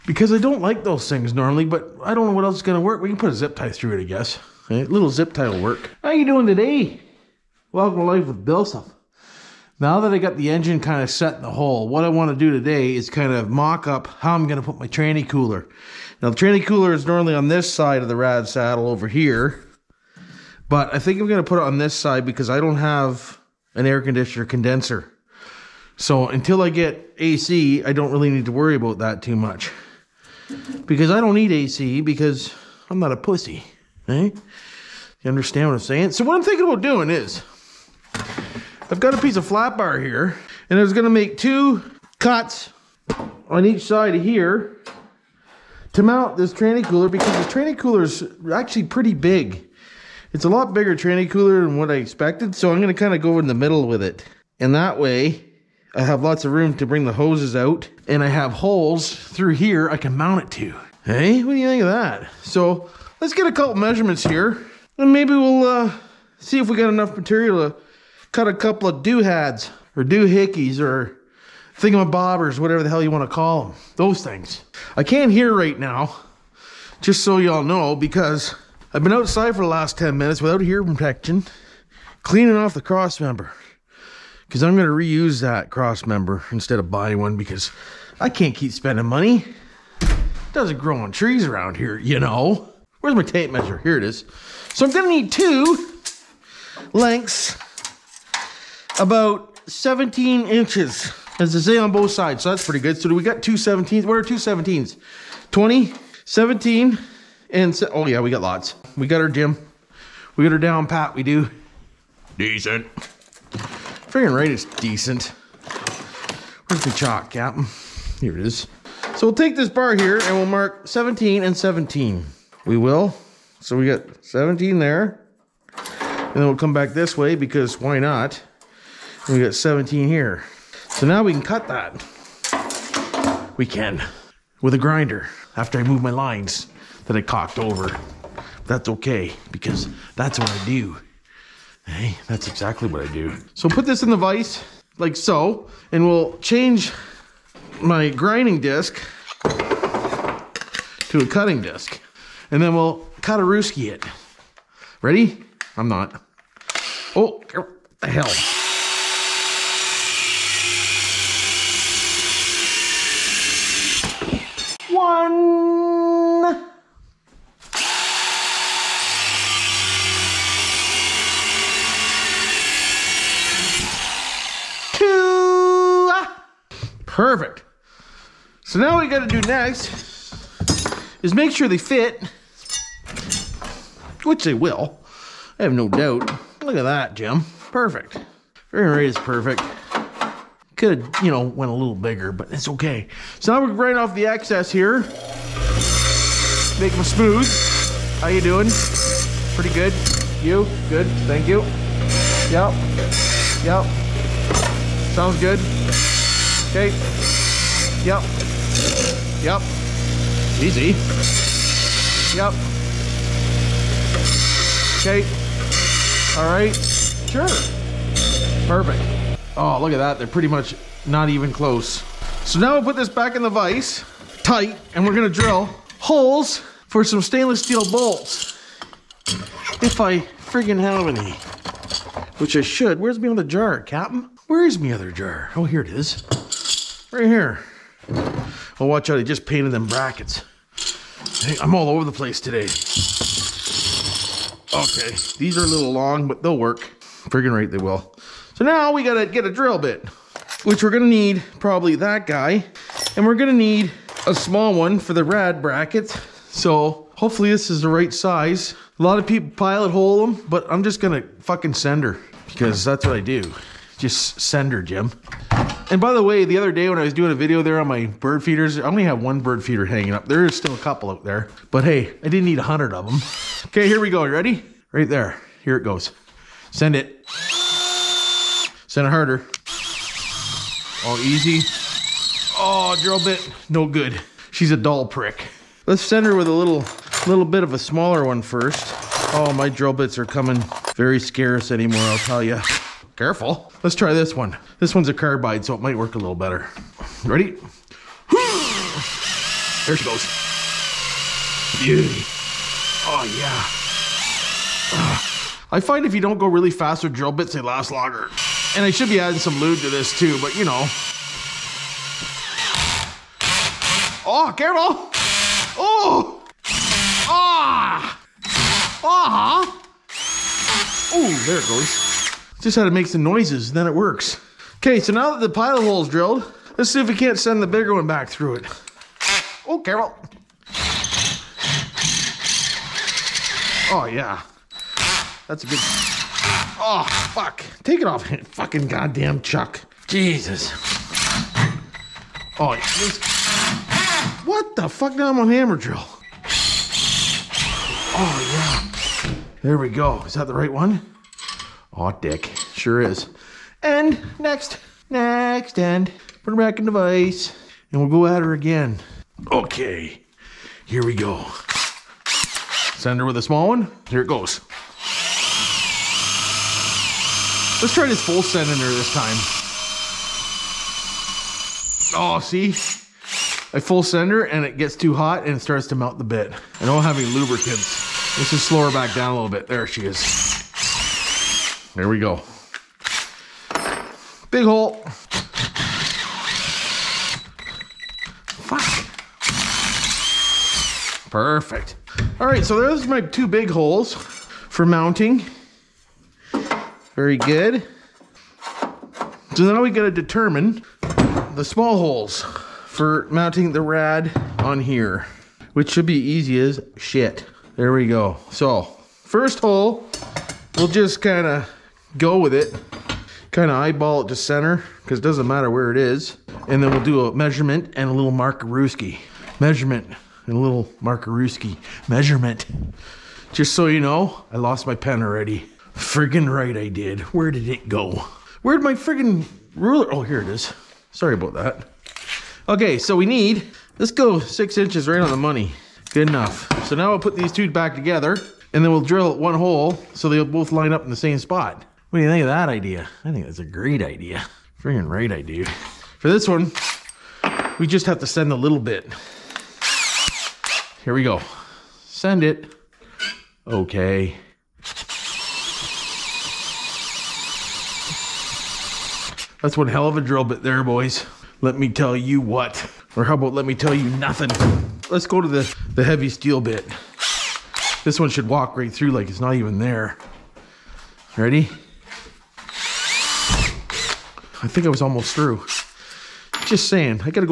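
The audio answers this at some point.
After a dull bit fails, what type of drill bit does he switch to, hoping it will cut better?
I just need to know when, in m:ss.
4:55.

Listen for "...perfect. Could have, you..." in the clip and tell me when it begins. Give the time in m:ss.
3:09.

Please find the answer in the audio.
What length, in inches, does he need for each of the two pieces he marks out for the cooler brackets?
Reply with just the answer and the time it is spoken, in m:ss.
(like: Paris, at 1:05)
17 inches, at 1:39.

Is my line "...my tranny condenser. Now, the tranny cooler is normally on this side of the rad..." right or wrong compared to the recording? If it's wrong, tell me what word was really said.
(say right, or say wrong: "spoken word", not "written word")
wrong: "cooler", not "condenser".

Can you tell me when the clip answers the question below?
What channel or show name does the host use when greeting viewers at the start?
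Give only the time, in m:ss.
0:08.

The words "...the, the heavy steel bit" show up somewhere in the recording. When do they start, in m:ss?
7:45.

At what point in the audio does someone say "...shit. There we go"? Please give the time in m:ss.
6:46.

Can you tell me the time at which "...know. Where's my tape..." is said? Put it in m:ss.
1:32.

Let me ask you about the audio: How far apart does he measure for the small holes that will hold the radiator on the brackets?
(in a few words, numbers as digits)
6 inches.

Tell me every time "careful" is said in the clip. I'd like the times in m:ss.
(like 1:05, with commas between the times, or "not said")
4:53, 5:14.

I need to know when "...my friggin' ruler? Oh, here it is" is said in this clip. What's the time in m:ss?
7:08.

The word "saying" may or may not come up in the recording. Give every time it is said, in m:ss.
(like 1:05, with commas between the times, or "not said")
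0:35, 7:56.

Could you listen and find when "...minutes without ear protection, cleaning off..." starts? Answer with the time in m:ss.
1:20.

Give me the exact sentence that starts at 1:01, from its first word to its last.
Hey, what do you think of that?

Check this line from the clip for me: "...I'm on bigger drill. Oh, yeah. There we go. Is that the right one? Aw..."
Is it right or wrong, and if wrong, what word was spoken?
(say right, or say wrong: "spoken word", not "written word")
wrong: "hammer", not "bigger".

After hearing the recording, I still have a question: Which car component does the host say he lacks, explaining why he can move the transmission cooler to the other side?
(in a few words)
air conditioner condenser.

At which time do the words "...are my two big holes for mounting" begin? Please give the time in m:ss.
6:33.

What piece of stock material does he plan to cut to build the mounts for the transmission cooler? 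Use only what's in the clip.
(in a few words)
flat bar.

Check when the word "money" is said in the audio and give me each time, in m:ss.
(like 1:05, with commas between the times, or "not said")
1:29, 7:15.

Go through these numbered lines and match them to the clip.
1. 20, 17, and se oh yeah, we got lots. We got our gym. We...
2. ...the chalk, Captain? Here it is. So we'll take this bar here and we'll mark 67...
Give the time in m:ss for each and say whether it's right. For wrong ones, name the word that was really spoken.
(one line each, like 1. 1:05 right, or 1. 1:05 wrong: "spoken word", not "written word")
1. 1:45 right
2. 1:56 wrong: "17", not "67".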